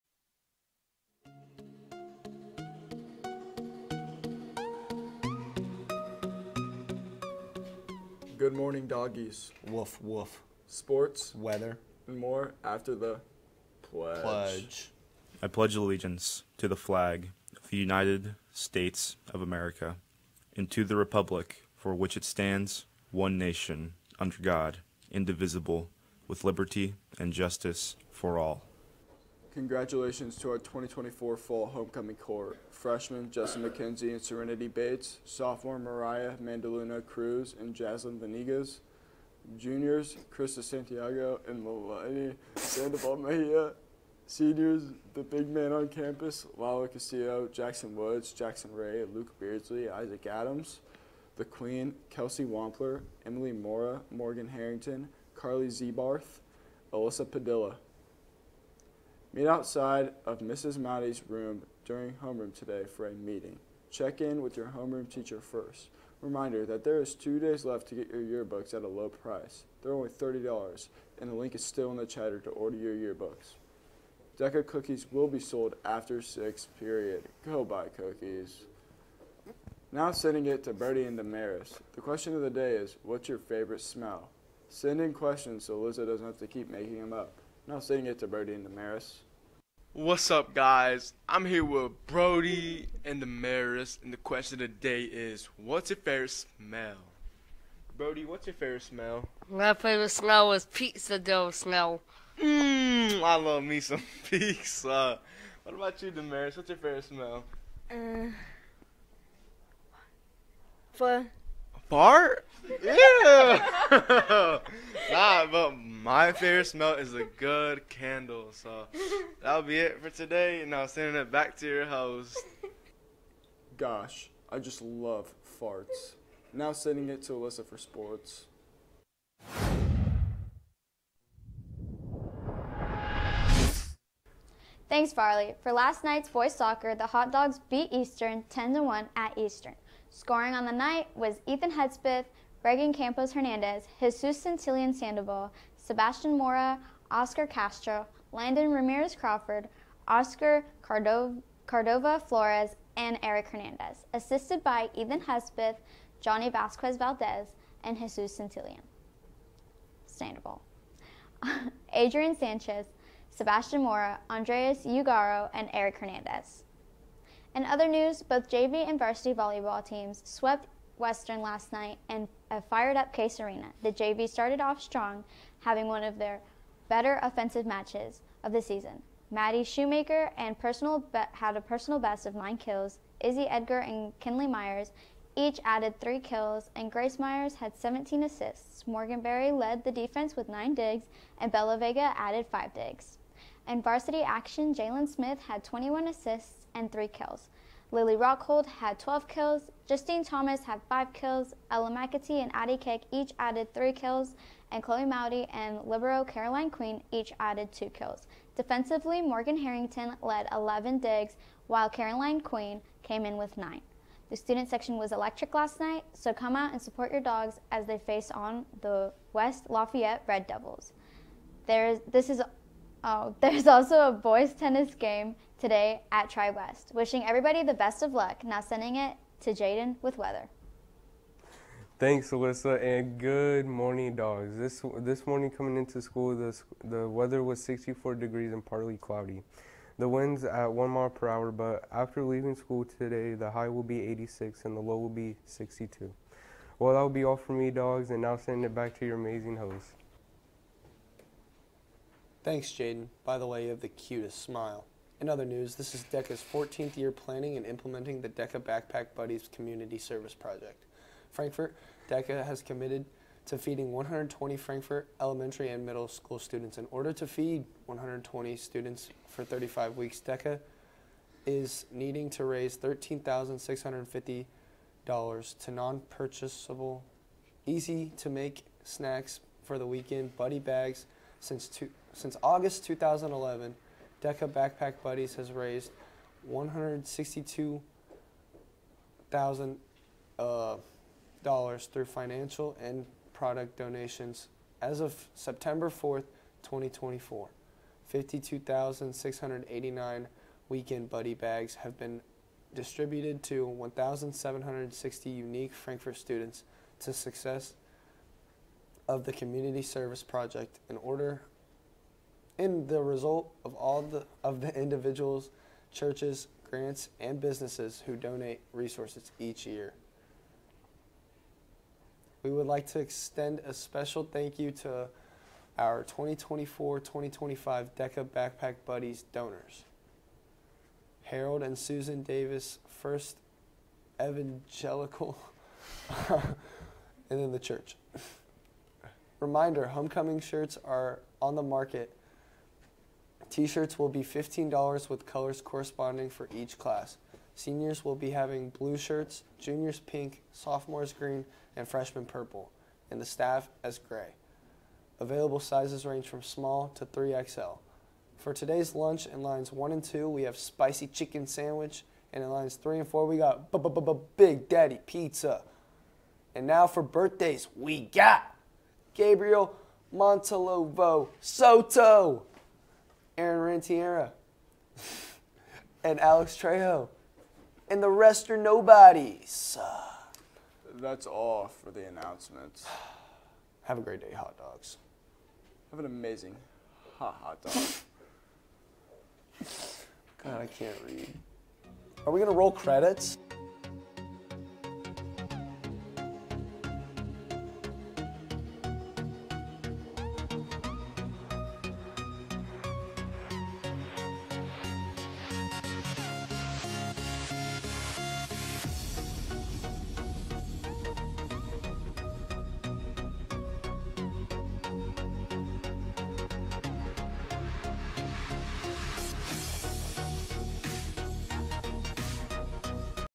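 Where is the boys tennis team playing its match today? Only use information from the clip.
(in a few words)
Tri West.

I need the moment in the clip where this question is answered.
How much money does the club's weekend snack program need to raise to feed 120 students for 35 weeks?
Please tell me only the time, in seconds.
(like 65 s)
272 s.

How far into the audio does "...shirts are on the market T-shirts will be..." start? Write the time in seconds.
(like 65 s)
340 s.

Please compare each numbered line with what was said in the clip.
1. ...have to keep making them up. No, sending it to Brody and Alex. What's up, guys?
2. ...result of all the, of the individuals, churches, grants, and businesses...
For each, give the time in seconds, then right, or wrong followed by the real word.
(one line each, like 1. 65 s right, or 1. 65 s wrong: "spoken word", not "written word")
1. 86 s wrong: "Damaris", not "Alex"
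2. 313 s right.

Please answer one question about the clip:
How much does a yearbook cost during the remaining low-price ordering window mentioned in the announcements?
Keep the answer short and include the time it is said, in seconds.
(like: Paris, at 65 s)
$30, at 70 s.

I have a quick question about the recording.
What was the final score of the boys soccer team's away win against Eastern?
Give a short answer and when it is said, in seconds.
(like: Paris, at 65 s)
10 to 1, at 138 s.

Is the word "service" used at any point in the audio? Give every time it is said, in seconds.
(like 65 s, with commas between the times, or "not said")
259 s, 309 s.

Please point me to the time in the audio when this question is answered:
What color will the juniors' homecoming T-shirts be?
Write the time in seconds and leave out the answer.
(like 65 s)
349 s.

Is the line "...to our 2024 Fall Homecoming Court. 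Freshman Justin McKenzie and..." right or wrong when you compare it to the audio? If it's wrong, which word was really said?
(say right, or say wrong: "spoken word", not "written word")
right.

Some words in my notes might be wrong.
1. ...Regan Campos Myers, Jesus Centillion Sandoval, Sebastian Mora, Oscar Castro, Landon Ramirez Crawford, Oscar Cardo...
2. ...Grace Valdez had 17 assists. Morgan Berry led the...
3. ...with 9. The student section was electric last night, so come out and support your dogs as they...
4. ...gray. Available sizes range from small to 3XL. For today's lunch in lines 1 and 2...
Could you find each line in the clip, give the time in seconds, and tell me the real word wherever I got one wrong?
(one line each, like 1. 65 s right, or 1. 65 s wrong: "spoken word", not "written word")
1. 142 s wrong: "Hernandez", not "Myers"
2. 186 s wrong: "Myers", not "Valdez"
3. 213 s right
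4. 353 s right.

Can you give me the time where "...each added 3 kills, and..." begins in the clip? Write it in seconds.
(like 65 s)
203 s.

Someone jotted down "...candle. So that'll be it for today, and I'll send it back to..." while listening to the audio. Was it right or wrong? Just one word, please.
right.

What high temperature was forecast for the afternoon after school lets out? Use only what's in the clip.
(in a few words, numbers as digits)
86.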